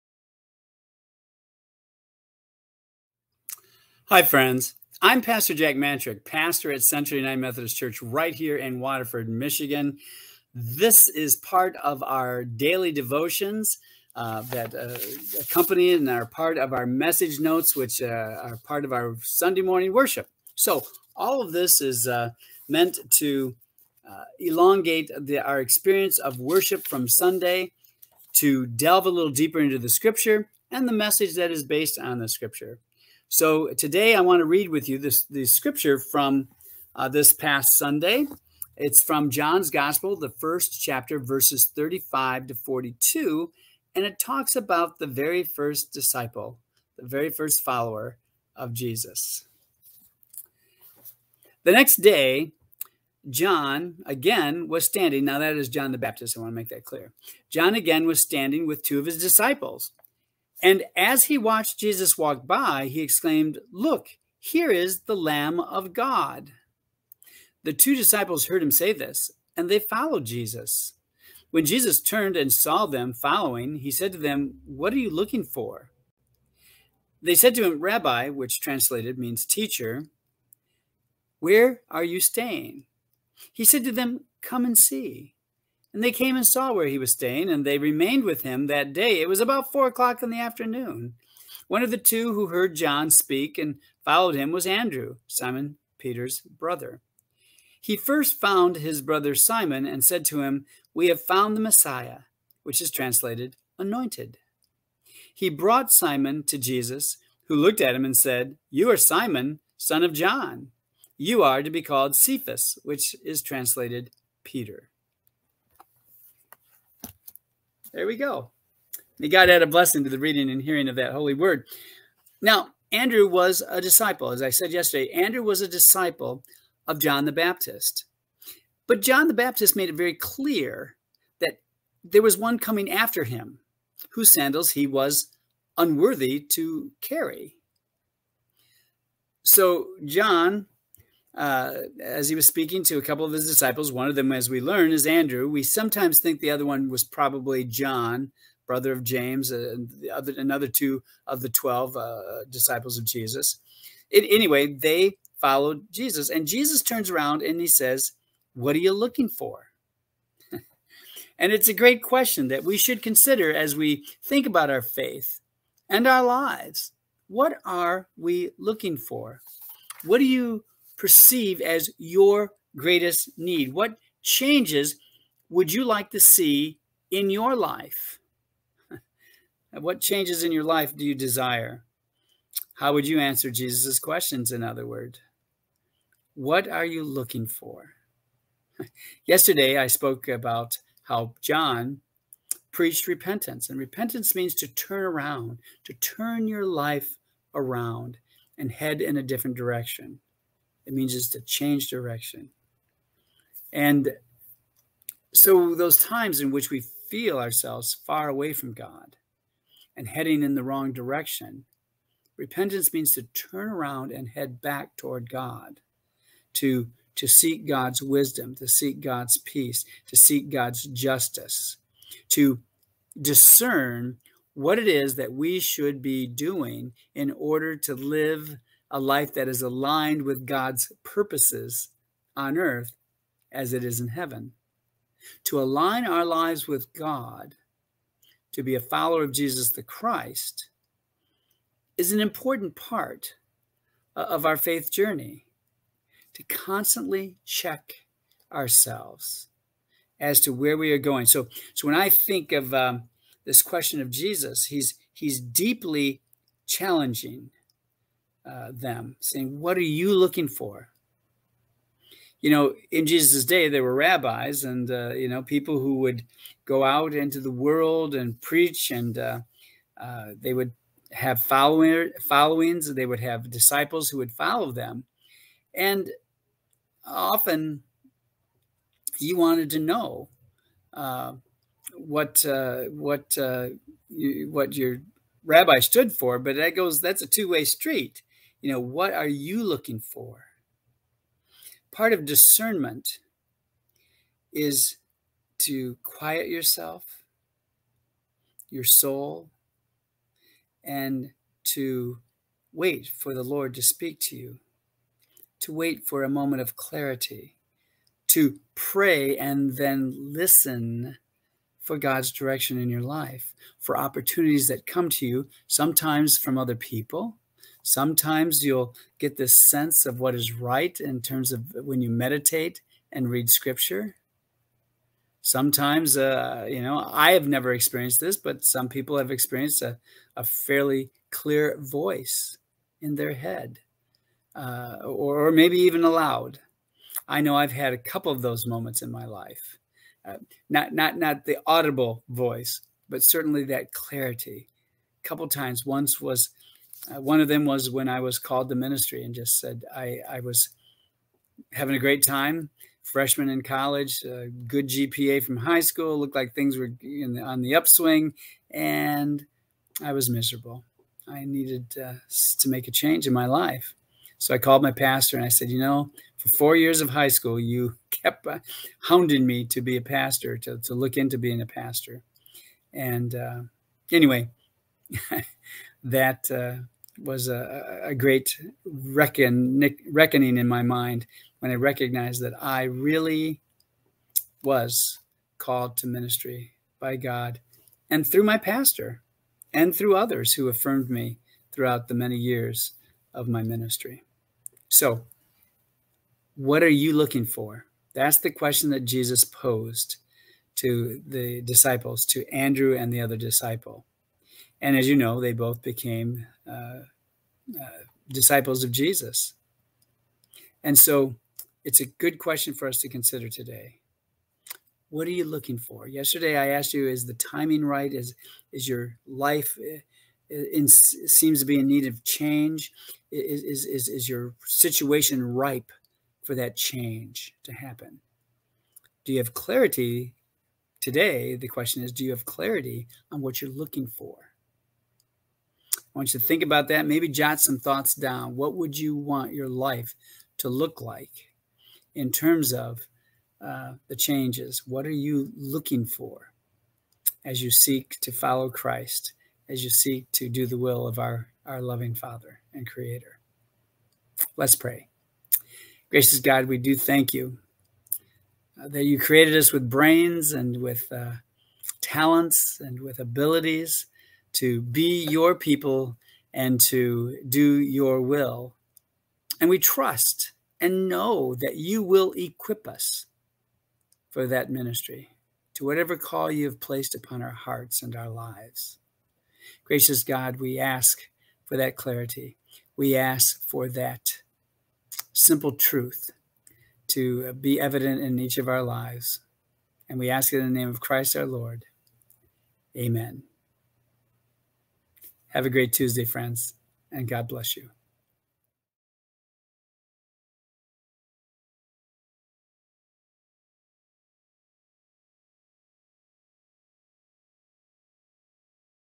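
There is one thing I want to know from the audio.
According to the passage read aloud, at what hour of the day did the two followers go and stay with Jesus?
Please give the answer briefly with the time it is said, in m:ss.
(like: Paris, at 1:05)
four o'clock, at 1:29.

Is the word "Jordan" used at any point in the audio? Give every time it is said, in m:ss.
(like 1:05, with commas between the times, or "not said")
not said.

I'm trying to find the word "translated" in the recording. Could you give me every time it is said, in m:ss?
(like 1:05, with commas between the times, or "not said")
1:18, 1:42, 1:53.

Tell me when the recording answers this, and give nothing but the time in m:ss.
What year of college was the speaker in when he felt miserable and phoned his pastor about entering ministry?
5:53.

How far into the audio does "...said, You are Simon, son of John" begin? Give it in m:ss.
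1:48.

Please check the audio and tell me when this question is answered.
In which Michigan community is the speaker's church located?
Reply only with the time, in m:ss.
0:08.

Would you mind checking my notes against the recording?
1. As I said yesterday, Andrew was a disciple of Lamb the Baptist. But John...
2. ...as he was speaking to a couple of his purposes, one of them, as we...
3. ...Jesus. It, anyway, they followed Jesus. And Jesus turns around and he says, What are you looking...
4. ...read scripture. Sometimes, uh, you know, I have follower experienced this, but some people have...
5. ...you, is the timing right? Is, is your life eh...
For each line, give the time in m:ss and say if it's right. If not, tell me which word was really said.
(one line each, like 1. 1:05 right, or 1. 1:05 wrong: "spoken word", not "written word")
1. 2:04 wrong: "John", not "Lamb"
2. 2:21 wrong: "disciples", not "purposes"
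3. 2:33 right
4. 5:23 wrong: "never", not "follower"
5. 6:56 right.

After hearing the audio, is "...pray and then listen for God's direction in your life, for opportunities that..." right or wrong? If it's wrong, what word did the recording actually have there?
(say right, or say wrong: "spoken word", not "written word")
right.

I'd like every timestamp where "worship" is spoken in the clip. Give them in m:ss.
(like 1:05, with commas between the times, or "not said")
0:19, 0:26.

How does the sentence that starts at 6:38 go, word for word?
That's the question that Jesus posed to the disciples, to Andrew and the other disciple.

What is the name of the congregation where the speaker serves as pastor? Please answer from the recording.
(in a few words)
Central United Methodist Church.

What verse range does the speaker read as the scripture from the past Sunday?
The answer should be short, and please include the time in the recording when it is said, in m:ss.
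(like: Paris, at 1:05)
35 to 42, at 0:41.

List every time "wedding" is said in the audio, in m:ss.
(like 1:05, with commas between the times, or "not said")
not said.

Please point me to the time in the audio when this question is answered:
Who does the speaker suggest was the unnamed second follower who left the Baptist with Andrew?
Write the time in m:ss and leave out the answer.
2:27.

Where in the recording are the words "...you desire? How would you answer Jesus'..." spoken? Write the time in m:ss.
3:01.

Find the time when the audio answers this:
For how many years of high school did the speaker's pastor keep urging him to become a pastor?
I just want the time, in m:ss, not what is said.
6:06.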